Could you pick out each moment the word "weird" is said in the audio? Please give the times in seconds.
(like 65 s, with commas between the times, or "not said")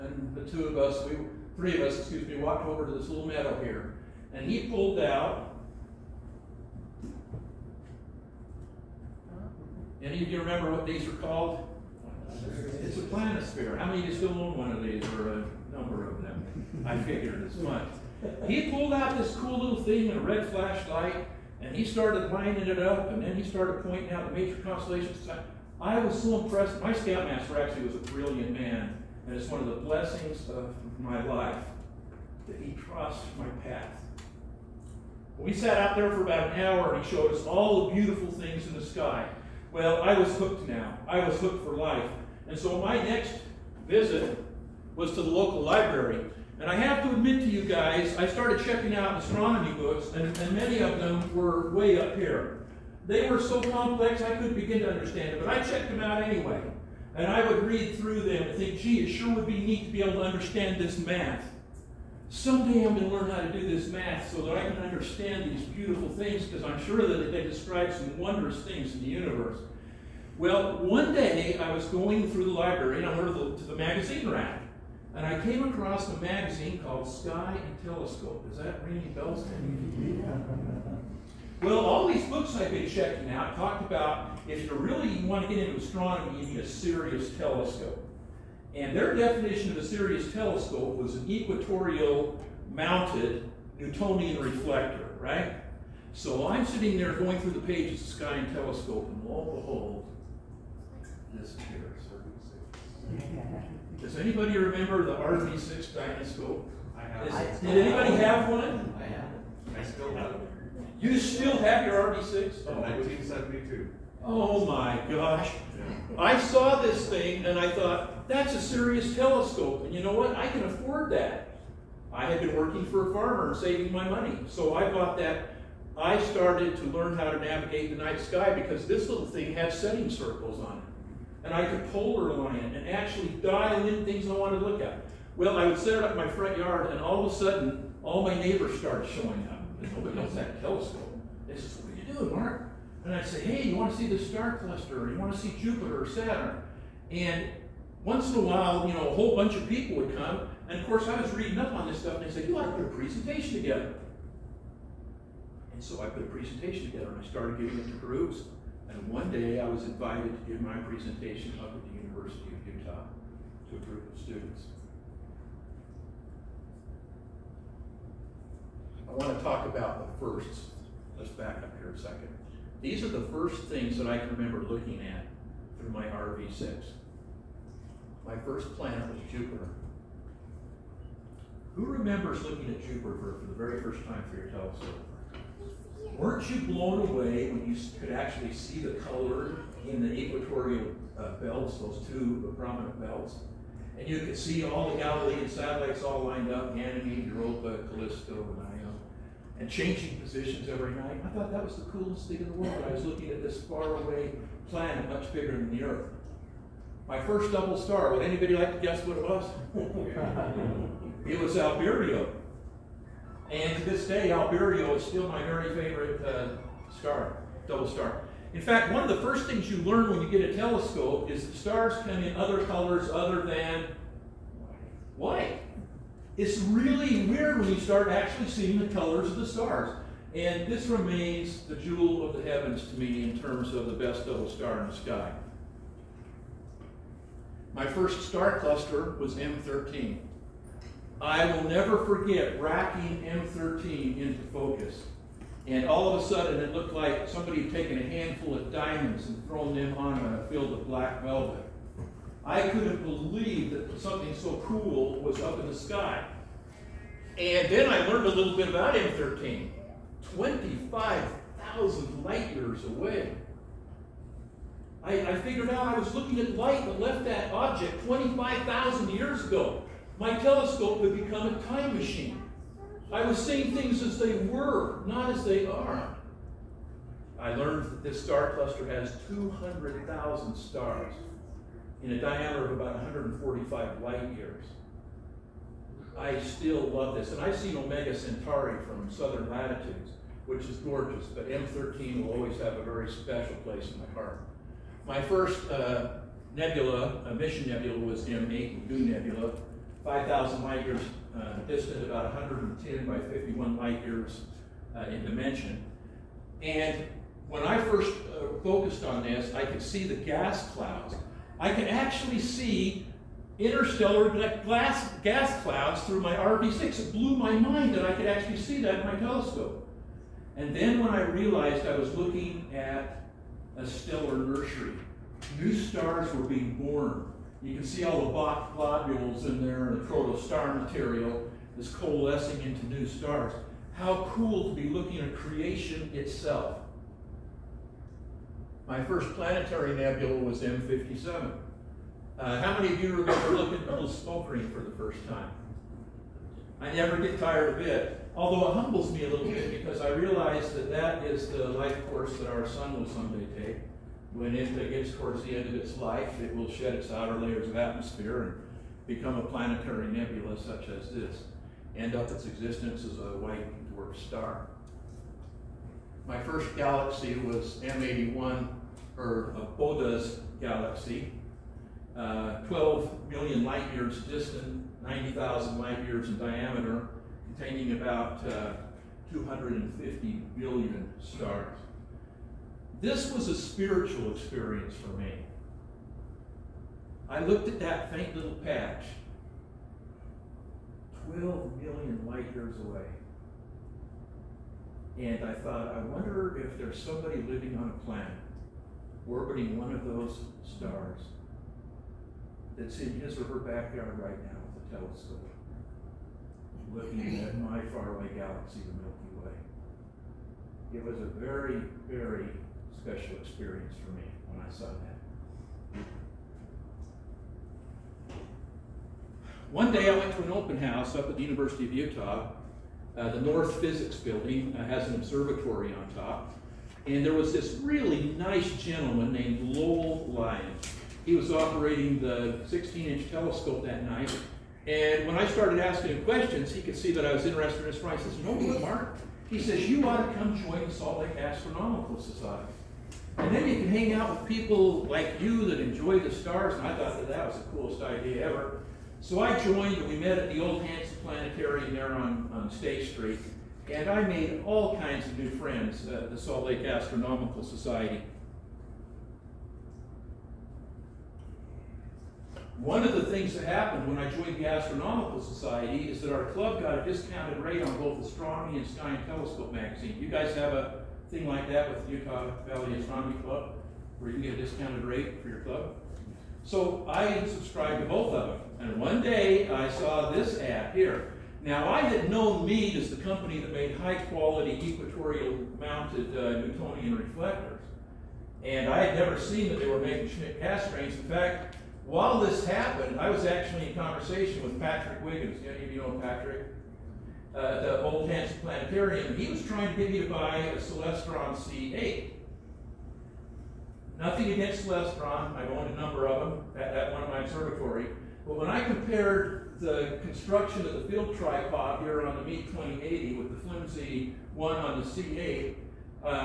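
227 s.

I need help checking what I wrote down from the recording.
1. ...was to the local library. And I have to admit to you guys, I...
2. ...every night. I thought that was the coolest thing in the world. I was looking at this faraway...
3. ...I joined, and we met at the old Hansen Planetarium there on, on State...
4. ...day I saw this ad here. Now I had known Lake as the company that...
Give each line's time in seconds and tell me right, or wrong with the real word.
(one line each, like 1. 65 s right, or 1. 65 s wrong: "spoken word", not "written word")
1. 44 s right
2. 200 s right
3. 449 s right
4. 479 s wrong: "Meade", not "Lake".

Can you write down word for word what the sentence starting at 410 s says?
It was a very, very special experience for me when I saw that.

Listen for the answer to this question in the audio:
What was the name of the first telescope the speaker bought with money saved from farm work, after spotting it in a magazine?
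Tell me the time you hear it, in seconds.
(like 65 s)
105 s.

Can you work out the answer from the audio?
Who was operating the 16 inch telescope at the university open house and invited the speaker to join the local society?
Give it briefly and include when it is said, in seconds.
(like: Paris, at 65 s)
Lowell Lyons, at 429 s.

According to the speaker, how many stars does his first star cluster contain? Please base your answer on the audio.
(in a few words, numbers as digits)
200,000.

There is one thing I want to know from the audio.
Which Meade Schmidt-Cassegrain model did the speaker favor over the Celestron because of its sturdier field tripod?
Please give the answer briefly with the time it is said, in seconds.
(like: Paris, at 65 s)
Meade 2080, at 512 s.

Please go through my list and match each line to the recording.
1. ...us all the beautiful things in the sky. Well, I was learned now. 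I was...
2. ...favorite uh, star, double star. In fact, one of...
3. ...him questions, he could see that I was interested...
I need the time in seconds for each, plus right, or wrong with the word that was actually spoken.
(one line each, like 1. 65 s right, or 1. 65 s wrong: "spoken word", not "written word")
1. 37 s wrong: "hooked", not "learned"
2. 215 s right
3. 436 s right.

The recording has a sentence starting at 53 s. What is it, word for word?
They were so complex I couldn't begin to understand it, but I checked them out anyway.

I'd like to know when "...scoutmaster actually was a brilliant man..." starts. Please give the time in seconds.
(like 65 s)
26 s.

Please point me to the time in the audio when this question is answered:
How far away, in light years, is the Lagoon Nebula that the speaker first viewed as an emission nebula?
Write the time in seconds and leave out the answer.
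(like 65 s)
300 s.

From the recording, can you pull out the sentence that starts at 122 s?
I had been working for a farmer and saving my money.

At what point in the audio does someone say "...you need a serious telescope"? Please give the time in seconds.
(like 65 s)
86 s.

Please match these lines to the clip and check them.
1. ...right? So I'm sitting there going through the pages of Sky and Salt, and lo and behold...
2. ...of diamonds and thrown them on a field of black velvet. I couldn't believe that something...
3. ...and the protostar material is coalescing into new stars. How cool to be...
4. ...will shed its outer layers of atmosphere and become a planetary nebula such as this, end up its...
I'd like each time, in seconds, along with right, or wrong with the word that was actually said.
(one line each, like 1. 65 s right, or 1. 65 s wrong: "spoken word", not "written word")
1. 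95 s wrong: "Telescope", not "Salt"
2. 248 s right
3. 329 s right
4. 356 s right.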